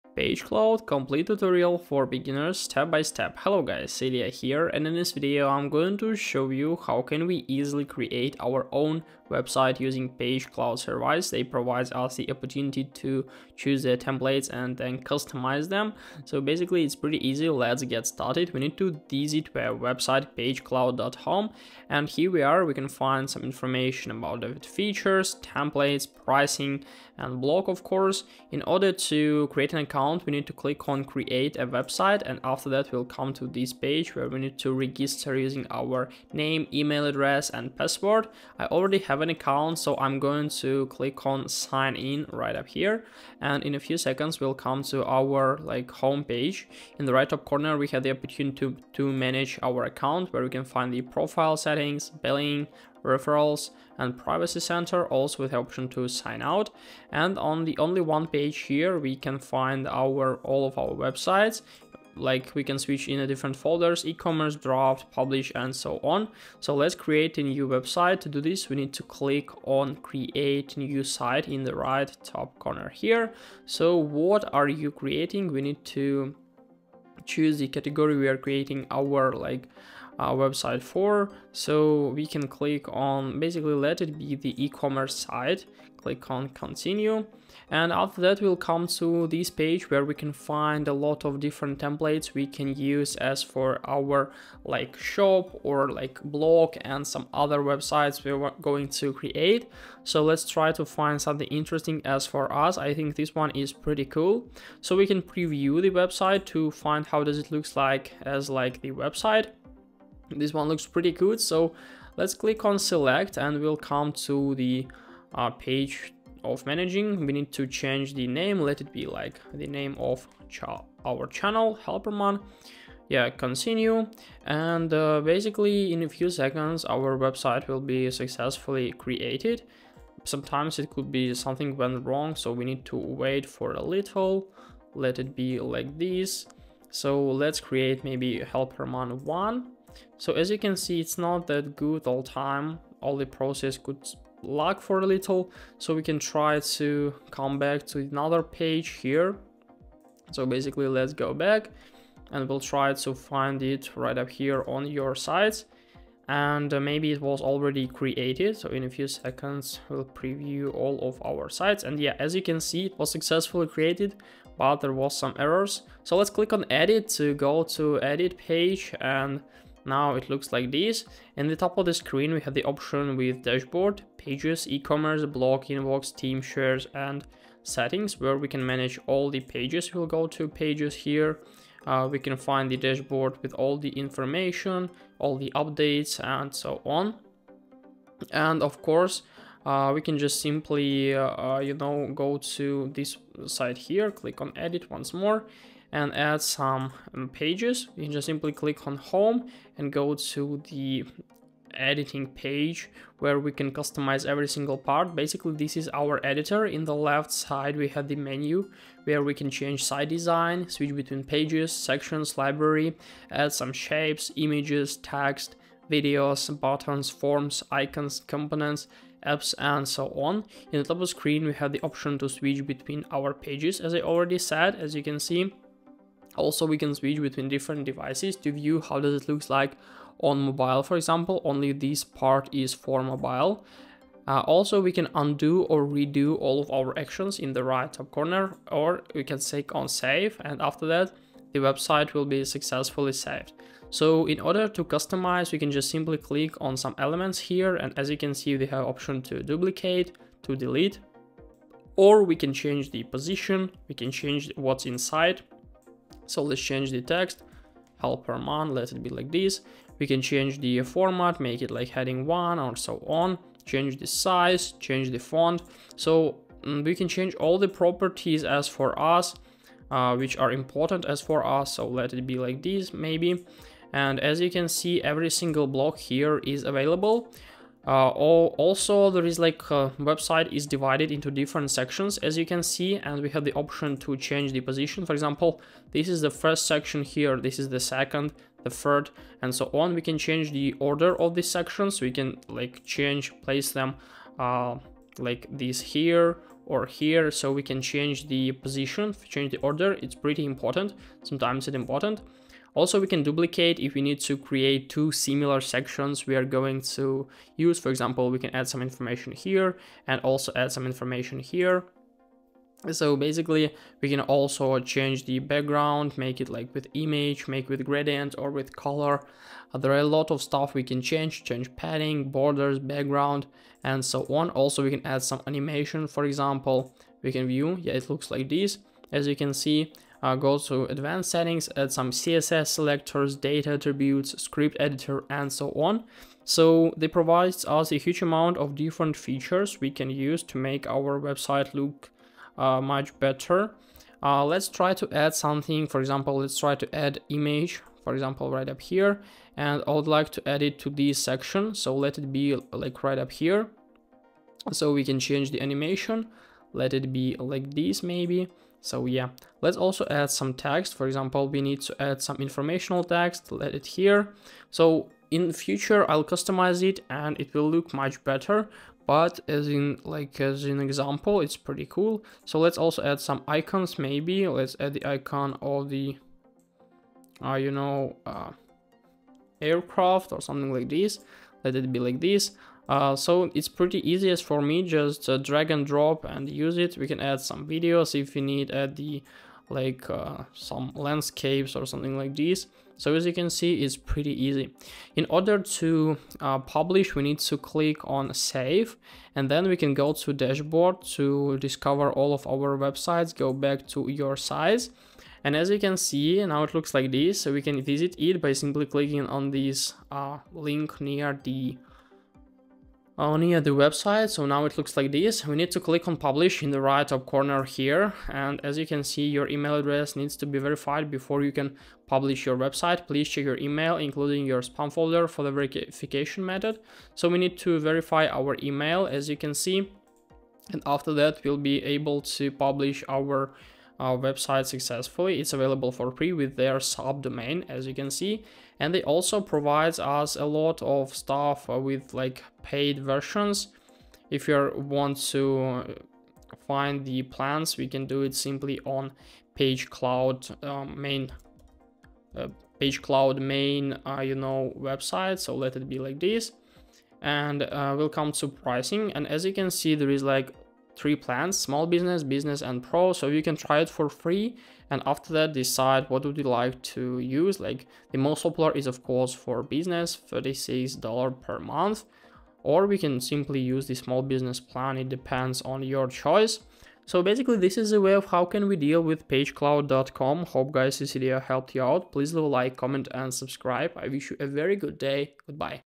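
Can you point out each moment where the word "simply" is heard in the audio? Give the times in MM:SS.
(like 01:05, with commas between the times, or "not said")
03:10, 03:18, 04:05, 06:48, 07:28, 07:53.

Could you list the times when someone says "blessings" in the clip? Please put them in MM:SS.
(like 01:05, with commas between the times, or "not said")
not said.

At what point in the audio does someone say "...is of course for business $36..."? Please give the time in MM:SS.
07:48.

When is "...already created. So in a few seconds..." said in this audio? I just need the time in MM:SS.
02:37.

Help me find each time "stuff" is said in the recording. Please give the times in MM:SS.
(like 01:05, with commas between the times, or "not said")
05:20, 07:21.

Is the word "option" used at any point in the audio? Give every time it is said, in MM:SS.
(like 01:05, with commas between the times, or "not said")
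00:55, 02:52, 03:41, 04:08, 04:43.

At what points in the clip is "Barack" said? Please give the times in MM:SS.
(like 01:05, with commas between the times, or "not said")
not said.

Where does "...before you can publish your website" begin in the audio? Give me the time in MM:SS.
07:01.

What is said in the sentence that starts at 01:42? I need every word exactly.
I think this one is pretty cool.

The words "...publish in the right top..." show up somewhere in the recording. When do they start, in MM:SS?
06:56.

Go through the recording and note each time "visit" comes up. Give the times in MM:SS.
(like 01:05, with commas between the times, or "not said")
00:19, 06:47.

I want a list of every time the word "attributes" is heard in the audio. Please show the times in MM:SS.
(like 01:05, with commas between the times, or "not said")
05:33.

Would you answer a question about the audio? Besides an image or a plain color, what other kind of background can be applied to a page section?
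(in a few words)
gradient.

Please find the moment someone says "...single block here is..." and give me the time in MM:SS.
04:35.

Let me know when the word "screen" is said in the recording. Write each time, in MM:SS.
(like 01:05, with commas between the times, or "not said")
02:51, 03:41.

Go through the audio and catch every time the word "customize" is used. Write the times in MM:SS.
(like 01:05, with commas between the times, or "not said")
00:14, 03:23, 04:04, 06:06.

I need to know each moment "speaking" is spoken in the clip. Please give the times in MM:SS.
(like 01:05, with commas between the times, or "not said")
not said.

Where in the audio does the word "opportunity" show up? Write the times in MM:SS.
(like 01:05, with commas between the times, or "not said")
00:12, 00:48.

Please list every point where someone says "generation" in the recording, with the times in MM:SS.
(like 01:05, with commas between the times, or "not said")
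not said.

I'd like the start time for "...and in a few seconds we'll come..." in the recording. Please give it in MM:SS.
00:43.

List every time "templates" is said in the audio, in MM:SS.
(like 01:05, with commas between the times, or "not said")
00:13, 00:25, 01:31.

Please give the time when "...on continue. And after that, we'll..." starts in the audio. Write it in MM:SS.
01:26.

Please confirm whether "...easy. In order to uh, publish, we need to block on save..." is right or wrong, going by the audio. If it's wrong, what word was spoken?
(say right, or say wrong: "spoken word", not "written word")
wrong: "click", not "block".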